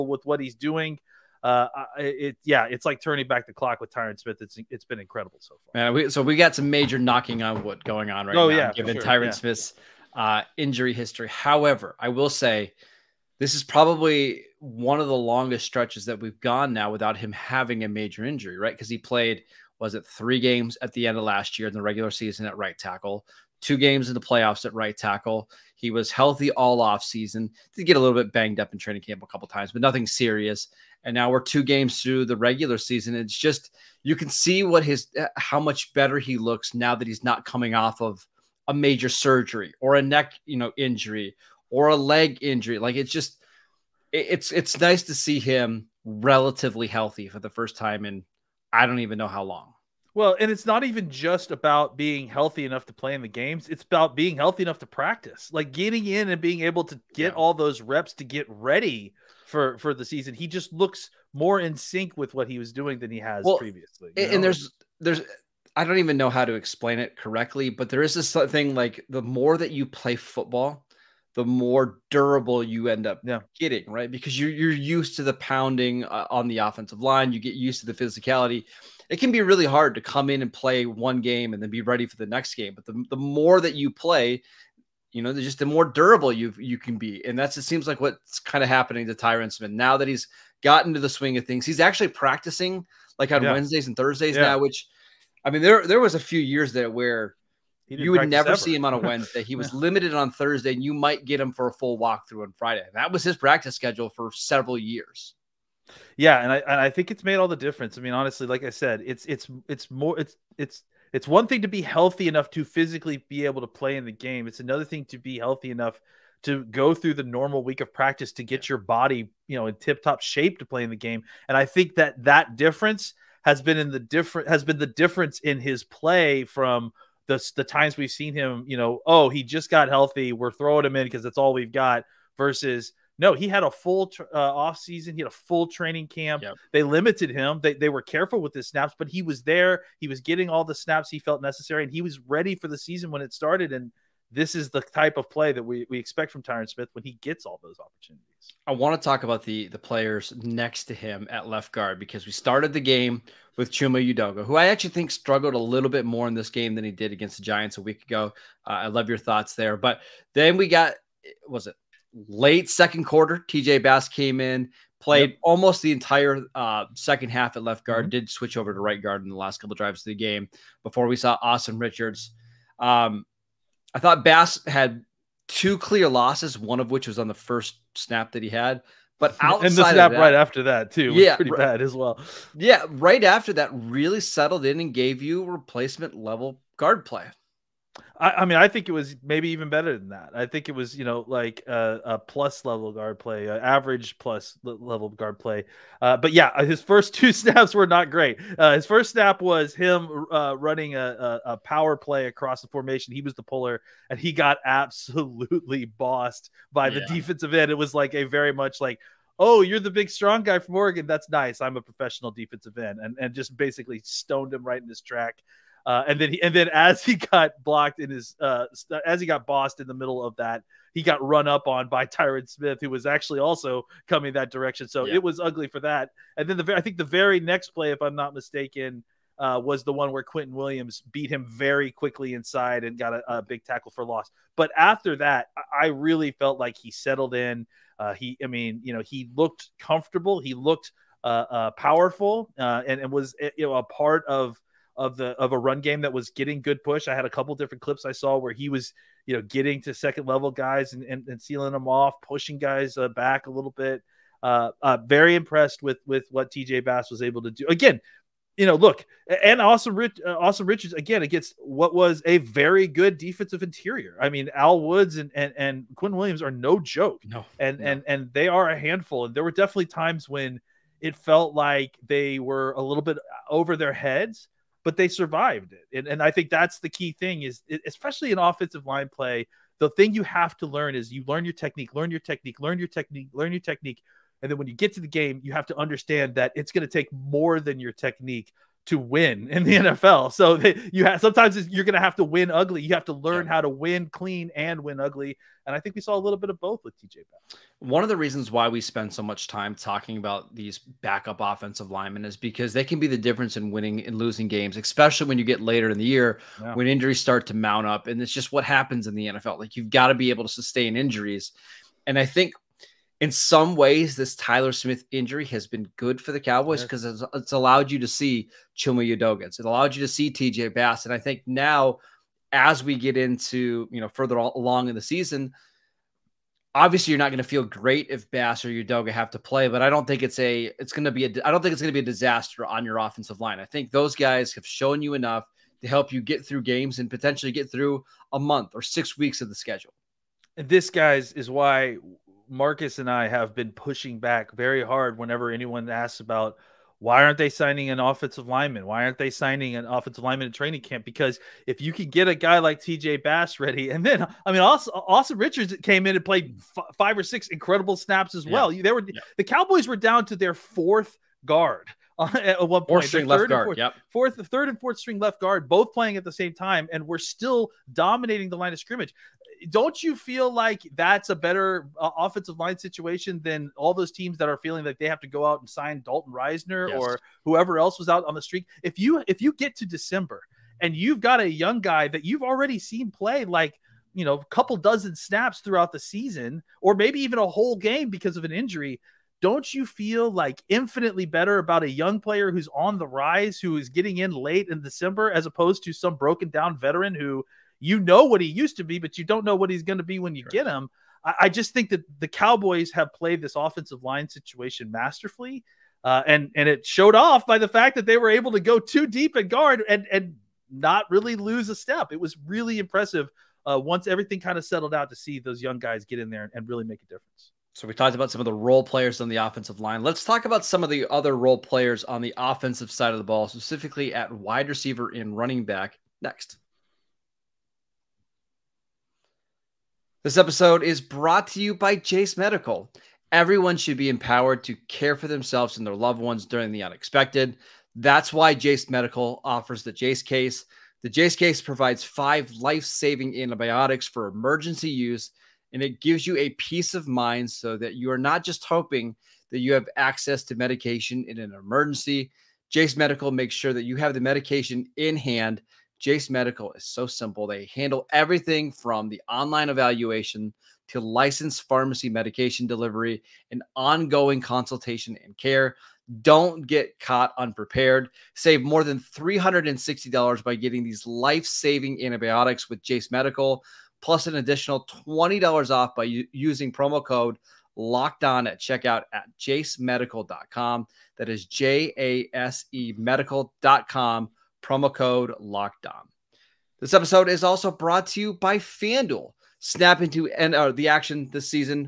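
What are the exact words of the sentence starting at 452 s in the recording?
Jase Medical makes sure that you have the medication in hand Jase Medical is so simple.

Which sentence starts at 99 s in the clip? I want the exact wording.
He was limited on Thursday, and you might get him for a full walkthrough on Friday.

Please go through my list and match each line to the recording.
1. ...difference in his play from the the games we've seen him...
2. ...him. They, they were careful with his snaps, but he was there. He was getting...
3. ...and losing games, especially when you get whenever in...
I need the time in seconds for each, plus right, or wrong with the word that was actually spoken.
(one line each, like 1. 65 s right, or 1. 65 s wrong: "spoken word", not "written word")
1. 124 s wrong: "times", not "games"
2. 137 s right
3. 304 s wrong: "later", not "whenever".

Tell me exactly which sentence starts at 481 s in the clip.
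That is J A S E medical.com promo code locked This episode is also brought to you by FanDuel.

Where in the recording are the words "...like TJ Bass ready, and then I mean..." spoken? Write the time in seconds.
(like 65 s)
352 s.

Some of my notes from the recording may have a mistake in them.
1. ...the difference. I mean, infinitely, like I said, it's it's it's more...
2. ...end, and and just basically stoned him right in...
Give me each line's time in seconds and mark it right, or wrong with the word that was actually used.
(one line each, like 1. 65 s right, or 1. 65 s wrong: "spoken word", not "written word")
1. 107 s wrong: "honestly", not "infinitely"
2. 212 s right.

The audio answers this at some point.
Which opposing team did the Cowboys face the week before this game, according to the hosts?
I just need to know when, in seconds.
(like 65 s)
157 s.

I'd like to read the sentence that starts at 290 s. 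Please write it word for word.
So they, you have sometimes you're going to have to win ugly.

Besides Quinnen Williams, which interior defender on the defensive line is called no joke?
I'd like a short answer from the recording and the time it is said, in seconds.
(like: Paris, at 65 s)
Al Woods, at 264 s.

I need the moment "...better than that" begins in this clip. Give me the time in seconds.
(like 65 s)
189 s.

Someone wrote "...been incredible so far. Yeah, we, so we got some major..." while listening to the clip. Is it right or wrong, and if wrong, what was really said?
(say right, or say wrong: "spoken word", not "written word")
right.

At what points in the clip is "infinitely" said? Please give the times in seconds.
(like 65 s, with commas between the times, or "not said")
390 s.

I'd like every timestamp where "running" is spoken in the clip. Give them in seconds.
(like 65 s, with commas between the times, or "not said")
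200 s, 425 s.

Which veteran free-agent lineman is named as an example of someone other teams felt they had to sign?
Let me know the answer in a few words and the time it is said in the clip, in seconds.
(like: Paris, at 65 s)
Dalton Risner, at 376 s.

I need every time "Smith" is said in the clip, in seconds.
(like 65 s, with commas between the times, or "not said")
4 s, 9 s, 89 s, 146 s, 222 s, 314 s.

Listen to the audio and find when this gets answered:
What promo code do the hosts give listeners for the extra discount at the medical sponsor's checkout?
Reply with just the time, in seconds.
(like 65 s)
477 s.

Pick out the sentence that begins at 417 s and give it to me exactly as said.
So we talked about some of the role players on the offensive line.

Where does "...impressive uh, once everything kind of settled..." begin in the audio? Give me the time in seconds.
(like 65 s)
412 s.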